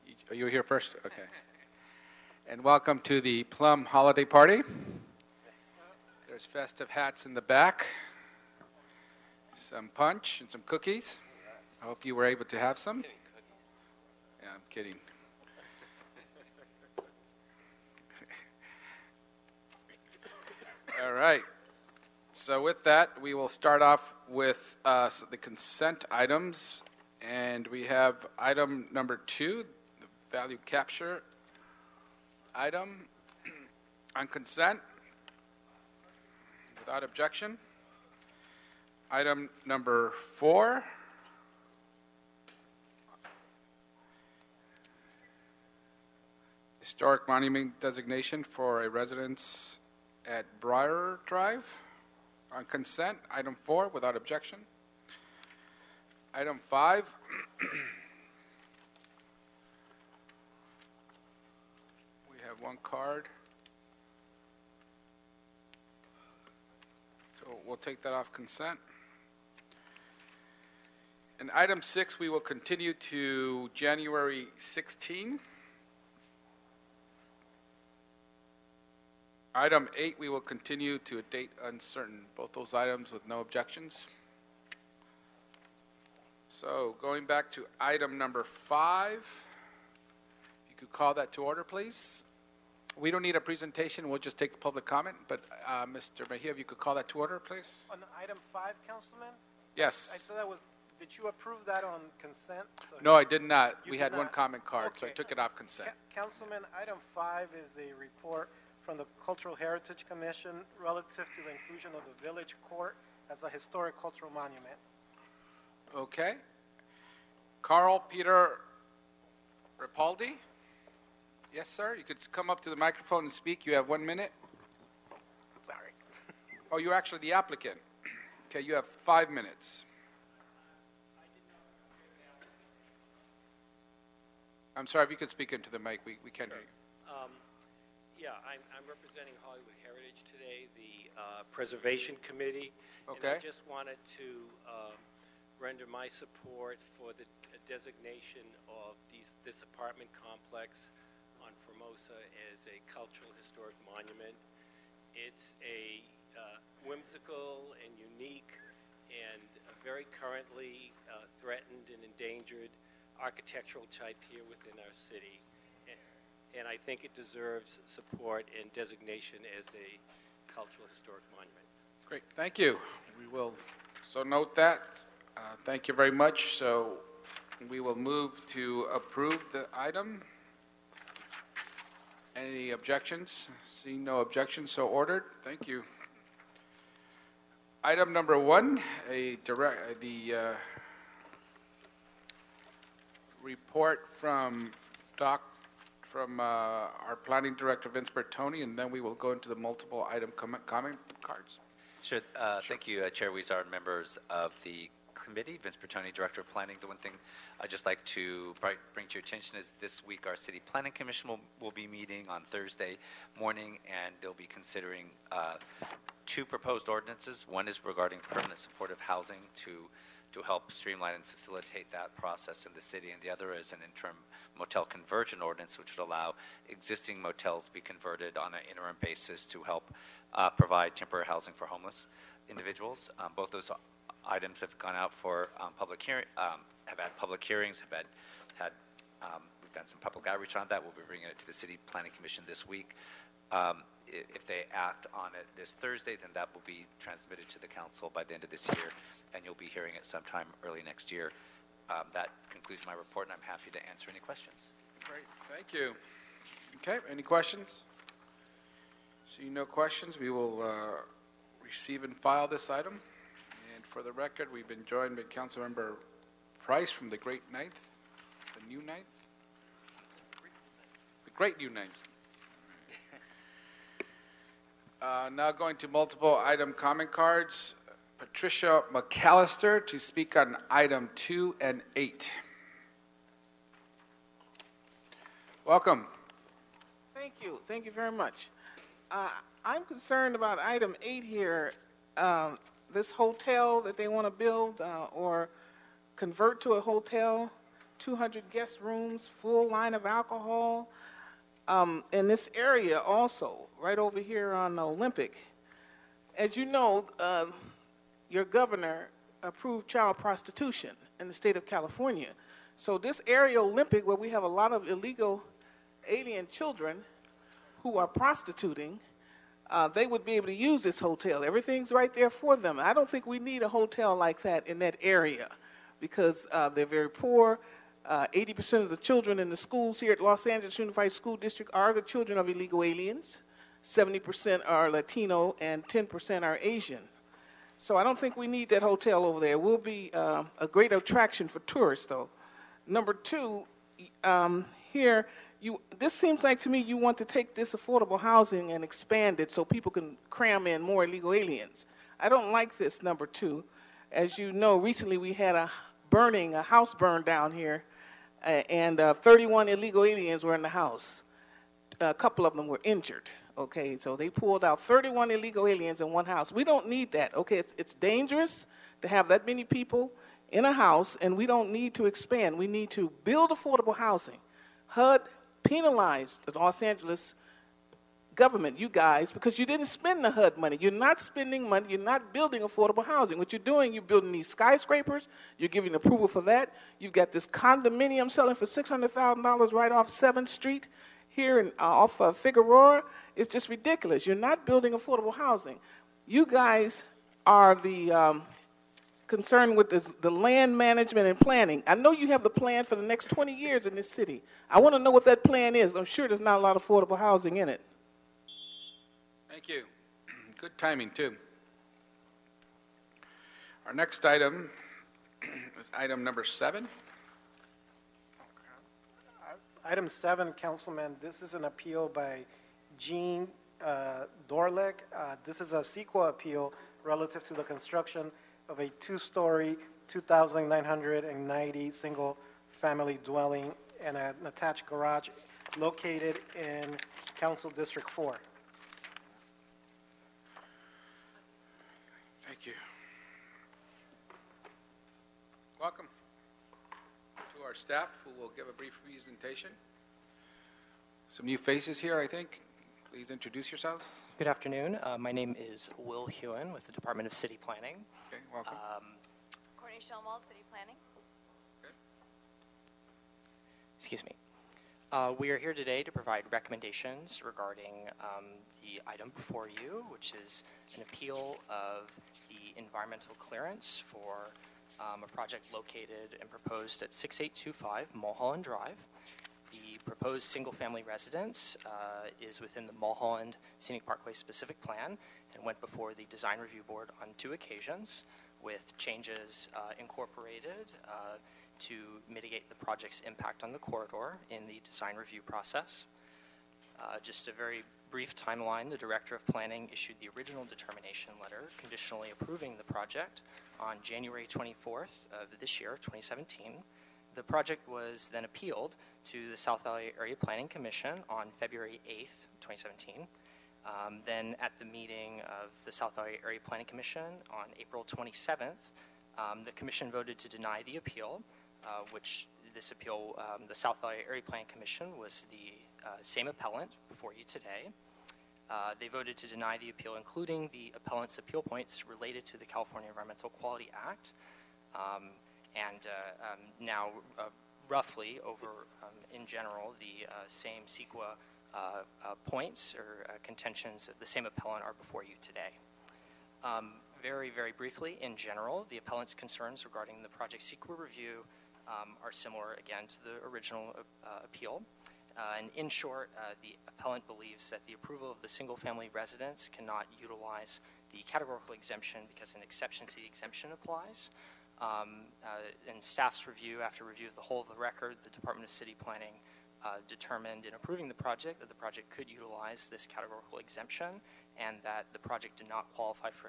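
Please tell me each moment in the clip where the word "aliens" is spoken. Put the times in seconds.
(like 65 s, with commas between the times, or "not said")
316 s, 332 s, 351 s, 360 s, 365 s.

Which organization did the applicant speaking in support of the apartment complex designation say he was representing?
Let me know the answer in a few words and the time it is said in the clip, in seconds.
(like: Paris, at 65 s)
Hollywood Heritage, at 139 s.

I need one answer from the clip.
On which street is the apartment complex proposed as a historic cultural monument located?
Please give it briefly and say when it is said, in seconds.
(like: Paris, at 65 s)
Formosa, at 151 s.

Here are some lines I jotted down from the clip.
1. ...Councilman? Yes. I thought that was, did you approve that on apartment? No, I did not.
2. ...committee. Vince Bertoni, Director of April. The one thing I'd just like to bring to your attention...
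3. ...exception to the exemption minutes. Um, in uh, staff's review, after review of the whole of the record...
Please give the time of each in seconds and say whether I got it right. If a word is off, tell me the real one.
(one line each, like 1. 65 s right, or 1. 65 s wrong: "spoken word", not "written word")
1. 98 s wrong: "consent", not "apartment"
2. 205 s wrong: "Planning", not "April"
3. 562 s wrong: "applies", not "minutes".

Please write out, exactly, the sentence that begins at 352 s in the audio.
I don't like this number two.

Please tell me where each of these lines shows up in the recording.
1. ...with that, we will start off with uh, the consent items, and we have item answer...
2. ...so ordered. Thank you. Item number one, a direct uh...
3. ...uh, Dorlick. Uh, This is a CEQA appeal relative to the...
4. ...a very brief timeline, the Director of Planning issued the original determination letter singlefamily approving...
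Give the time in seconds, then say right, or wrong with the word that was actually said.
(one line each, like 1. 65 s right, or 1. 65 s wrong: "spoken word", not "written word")
1. 22 s wrong: "number", not "answer"
2. 184 s right
3. 423 s right
4. 497 s wrong: "conditionally", not "singlefamily".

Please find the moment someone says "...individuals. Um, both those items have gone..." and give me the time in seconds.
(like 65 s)
232 s.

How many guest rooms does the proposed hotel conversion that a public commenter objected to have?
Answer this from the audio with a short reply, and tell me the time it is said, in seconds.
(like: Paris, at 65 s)
200, at 297 s.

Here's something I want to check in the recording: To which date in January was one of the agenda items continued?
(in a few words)
January 16.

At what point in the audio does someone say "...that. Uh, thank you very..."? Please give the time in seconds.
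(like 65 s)
174 s.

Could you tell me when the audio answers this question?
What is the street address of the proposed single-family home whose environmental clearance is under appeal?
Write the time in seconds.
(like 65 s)
477 s.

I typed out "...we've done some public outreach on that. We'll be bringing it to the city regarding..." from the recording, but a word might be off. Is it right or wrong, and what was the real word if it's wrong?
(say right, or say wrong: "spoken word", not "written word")
wrong: "planning", not "regarding".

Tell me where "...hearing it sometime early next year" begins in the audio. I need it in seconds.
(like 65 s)
249 s.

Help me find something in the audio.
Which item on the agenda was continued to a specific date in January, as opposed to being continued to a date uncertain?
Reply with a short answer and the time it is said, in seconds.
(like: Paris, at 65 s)
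Item 6, at 71 s.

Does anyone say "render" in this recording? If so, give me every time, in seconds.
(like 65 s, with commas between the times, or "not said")
145 s.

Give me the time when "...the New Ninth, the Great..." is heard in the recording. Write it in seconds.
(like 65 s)
268 s.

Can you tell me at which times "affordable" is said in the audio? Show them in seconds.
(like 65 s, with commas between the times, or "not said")
347 s, 373 s, 382 s, 394 s, 406 s.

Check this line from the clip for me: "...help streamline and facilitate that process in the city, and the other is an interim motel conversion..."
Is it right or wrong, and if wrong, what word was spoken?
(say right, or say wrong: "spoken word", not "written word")
right.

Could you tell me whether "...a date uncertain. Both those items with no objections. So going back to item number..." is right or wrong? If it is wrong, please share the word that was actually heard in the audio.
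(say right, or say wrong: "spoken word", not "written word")
right.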